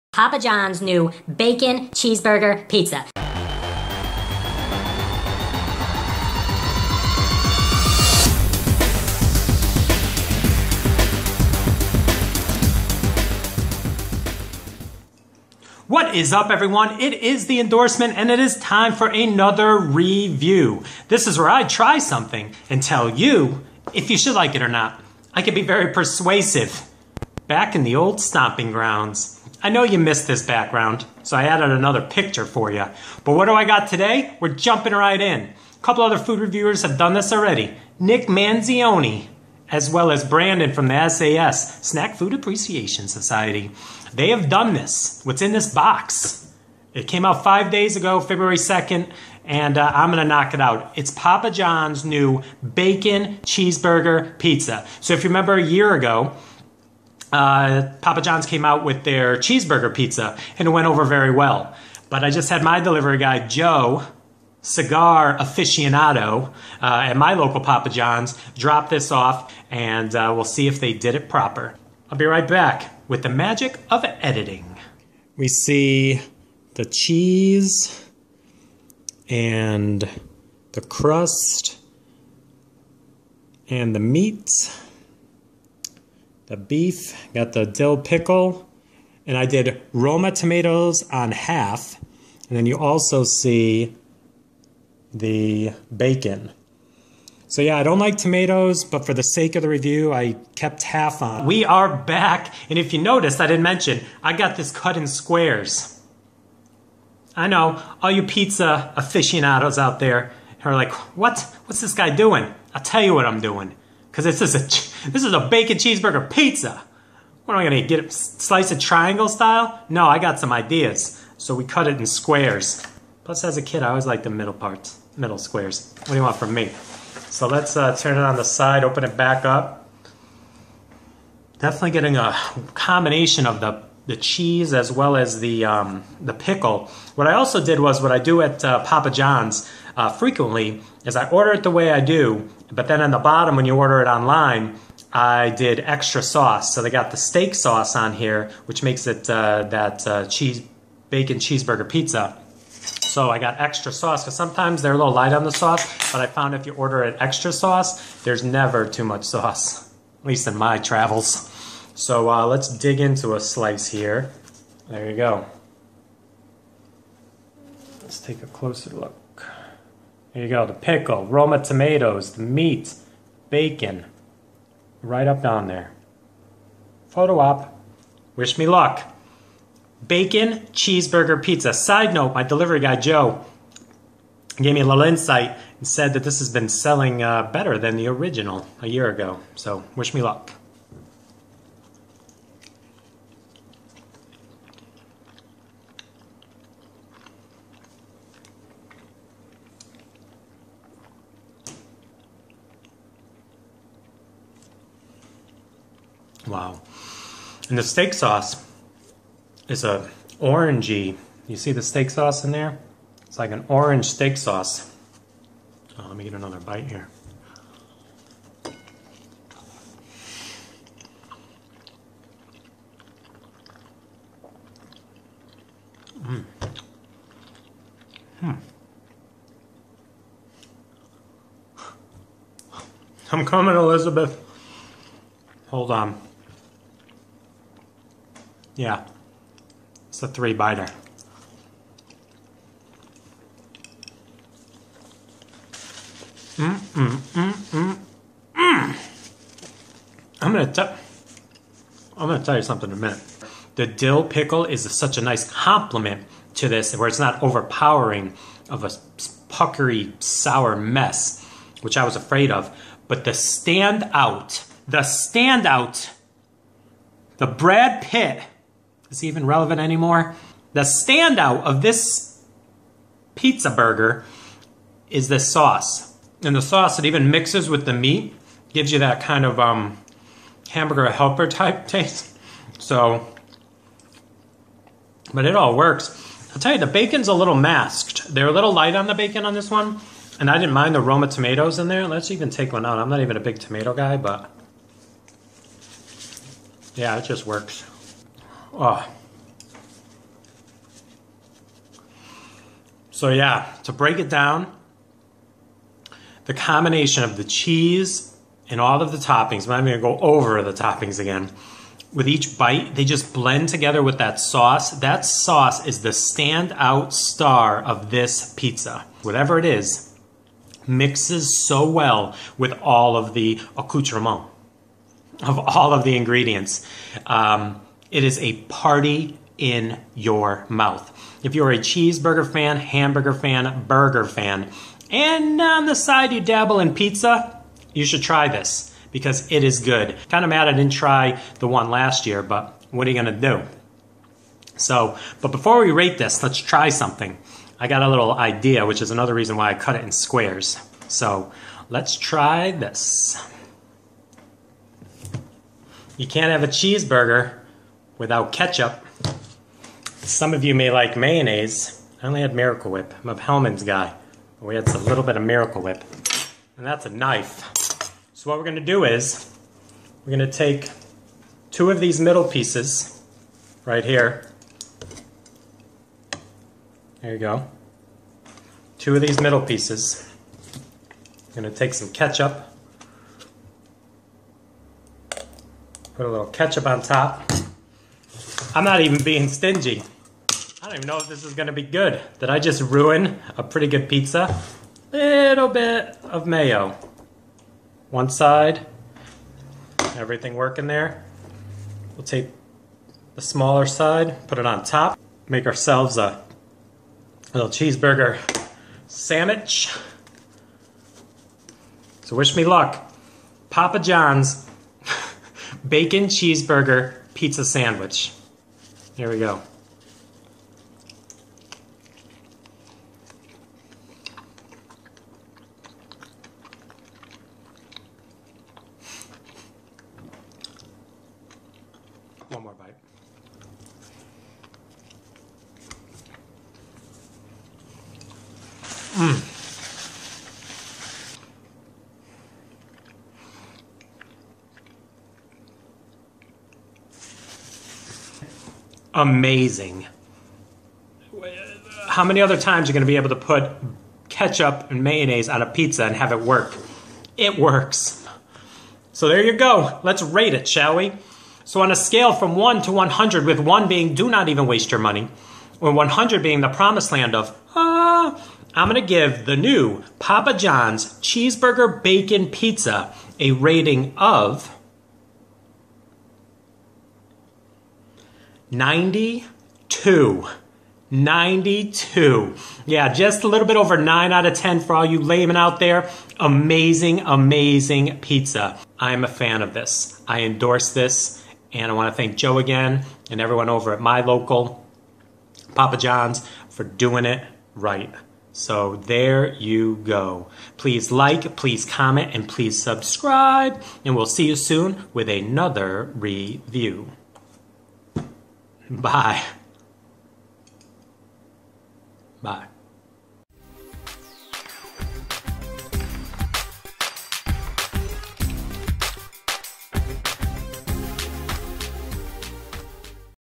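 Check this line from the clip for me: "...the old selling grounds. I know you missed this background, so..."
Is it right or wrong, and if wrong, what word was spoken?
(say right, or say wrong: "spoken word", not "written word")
wrong: "stomping", not "selling".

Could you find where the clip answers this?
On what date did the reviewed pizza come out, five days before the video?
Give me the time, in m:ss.
0:48.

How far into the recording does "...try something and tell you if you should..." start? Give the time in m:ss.
0:21.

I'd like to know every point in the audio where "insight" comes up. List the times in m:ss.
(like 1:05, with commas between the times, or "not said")
3:05.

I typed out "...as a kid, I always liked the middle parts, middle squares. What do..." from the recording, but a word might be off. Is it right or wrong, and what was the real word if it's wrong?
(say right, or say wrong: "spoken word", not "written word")
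right.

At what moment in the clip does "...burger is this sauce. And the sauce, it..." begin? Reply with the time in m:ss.
4:33.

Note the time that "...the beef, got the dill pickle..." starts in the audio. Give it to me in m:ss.
1:26.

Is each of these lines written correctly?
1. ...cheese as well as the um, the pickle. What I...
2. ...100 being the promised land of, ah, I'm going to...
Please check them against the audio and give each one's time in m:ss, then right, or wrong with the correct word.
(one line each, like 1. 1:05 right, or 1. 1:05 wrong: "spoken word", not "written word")
1. 2:14 right
2. 7:45 right.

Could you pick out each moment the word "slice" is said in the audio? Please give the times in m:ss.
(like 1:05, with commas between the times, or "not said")
1:58, 2:43.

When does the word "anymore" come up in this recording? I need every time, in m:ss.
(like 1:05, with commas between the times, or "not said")
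4:29.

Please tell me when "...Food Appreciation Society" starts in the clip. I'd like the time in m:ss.
0:42.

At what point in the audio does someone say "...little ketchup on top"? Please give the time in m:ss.
6:26.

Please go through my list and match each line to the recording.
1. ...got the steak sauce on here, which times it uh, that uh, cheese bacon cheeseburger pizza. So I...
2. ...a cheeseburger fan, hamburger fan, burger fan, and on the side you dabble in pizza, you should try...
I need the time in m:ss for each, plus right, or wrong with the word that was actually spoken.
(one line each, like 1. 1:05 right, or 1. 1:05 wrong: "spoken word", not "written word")
1. 2:26 wrong: "makes", not "times"
2. 5:31 right.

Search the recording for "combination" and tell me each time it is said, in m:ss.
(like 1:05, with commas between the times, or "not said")
2:12, 5:06.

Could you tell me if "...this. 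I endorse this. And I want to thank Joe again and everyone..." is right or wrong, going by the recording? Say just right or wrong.
right.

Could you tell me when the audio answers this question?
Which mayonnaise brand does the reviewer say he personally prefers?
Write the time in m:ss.
6:03.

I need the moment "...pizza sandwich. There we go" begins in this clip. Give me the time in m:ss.
6:57.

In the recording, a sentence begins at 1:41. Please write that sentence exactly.
We are back, and if you noticed, I didn't mention, I got this cut in squares.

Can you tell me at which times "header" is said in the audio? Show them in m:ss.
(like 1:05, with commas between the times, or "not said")
not said.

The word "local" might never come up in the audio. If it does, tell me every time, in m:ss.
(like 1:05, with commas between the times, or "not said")
1:07, 8:14.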